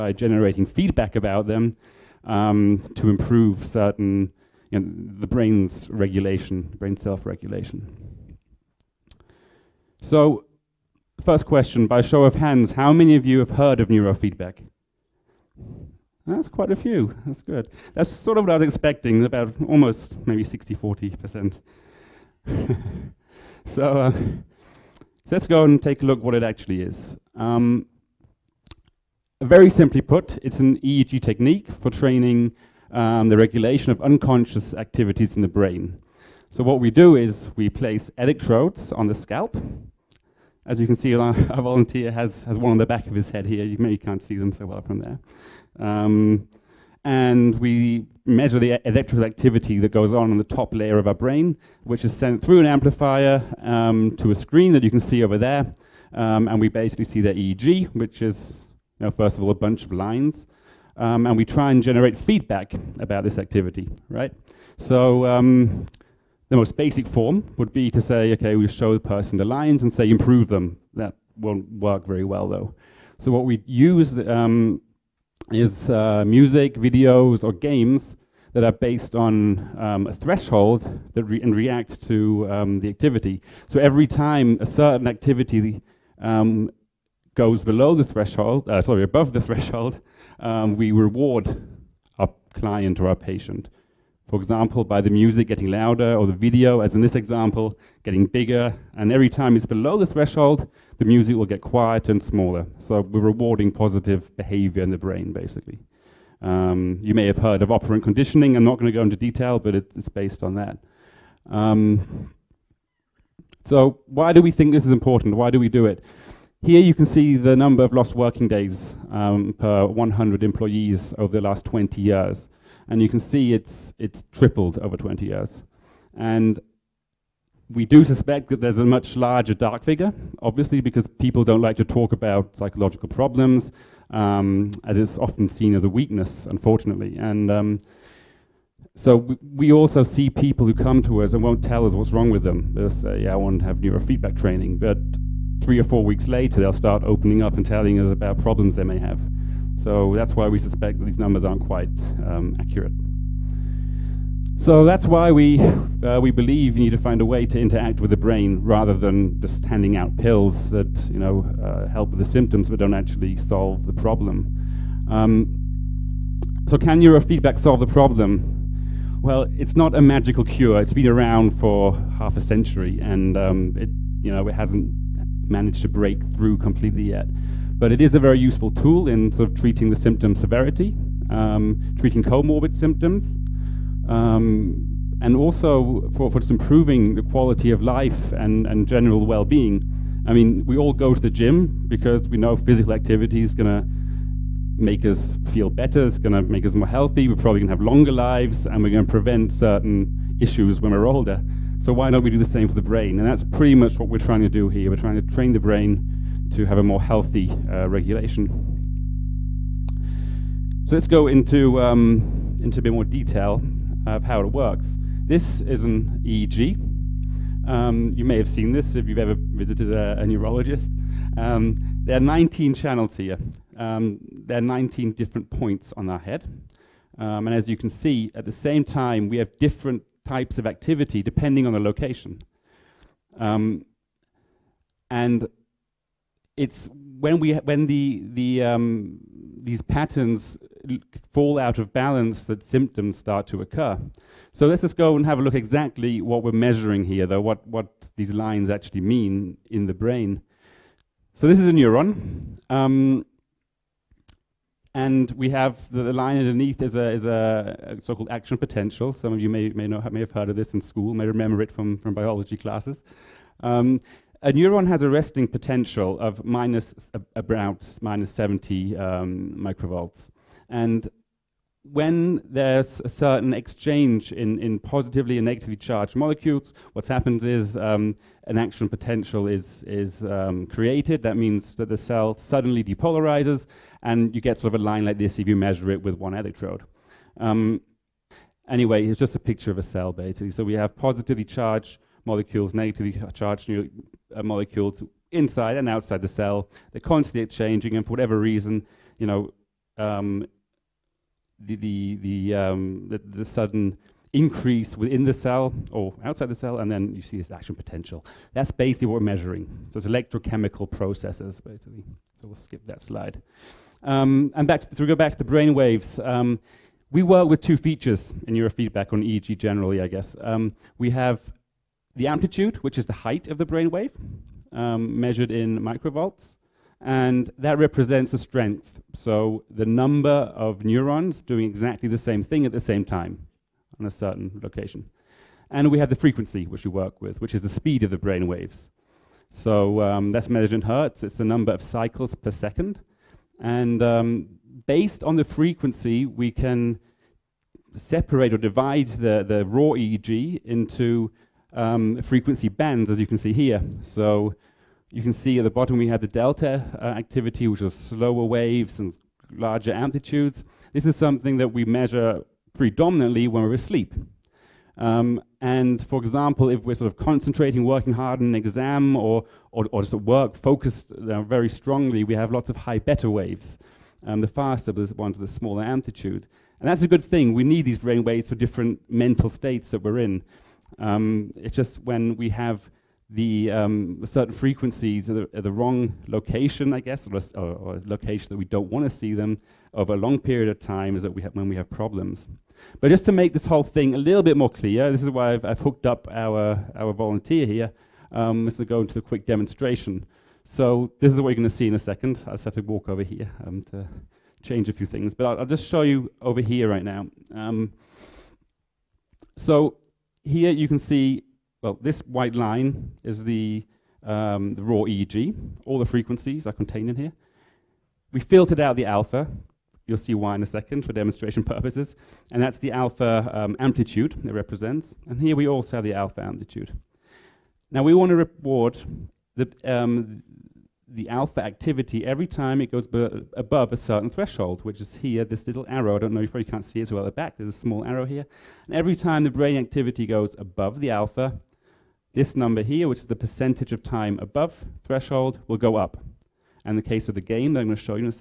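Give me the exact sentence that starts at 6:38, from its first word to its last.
Um, this will go into a quick demonstration.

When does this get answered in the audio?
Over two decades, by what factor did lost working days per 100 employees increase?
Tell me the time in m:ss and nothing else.
2:04.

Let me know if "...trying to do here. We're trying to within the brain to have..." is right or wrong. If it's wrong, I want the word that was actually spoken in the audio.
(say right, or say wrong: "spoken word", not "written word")
wrong: "train", not "within".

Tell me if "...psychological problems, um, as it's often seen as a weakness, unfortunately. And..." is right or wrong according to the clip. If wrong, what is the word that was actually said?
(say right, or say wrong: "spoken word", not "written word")
right.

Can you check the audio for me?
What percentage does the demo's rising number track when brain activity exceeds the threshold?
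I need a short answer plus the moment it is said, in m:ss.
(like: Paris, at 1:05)
time above threshold, at 7:24.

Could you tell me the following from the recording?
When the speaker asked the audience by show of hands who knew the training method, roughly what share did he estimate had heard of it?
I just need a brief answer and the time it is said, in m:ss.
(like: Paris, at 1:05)
60, 40%, at 0:20.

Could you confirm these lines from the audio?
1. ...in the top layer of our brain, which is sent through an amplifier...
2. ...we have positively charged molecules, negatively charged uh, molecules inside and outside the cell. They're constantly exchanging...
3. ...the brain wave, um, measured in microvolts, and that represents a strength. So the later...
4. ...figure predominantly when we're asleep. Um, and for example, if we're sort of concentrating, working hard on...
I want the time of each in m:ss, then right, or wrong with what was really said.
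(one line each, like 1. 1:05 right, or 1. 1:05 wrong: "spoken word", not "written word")
1. 0:50 right
2. 4:50 right
3. 5:23 wrong: "number", not "later"
4. 6:01 wrong: "measure", not "figure".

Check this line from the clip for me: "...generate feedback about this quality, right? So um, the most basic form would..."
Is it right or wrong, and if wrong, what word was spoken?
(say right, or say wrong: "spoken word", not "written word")
wrong: "activity", not "quality".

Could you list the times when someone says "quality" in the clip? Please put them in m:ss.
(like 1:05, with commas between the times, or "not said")
3:07.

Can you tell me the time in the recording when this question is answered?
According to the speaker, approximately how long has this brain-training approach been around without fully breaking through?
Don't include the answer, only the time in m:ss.
2:52.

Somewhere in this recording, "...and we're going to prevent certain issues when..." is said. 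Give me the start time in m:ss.
3:18.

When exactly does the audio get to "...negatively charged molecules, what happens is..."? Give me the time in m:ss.
4:35.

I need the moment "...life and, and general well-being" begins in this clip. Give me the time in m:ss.
3:07.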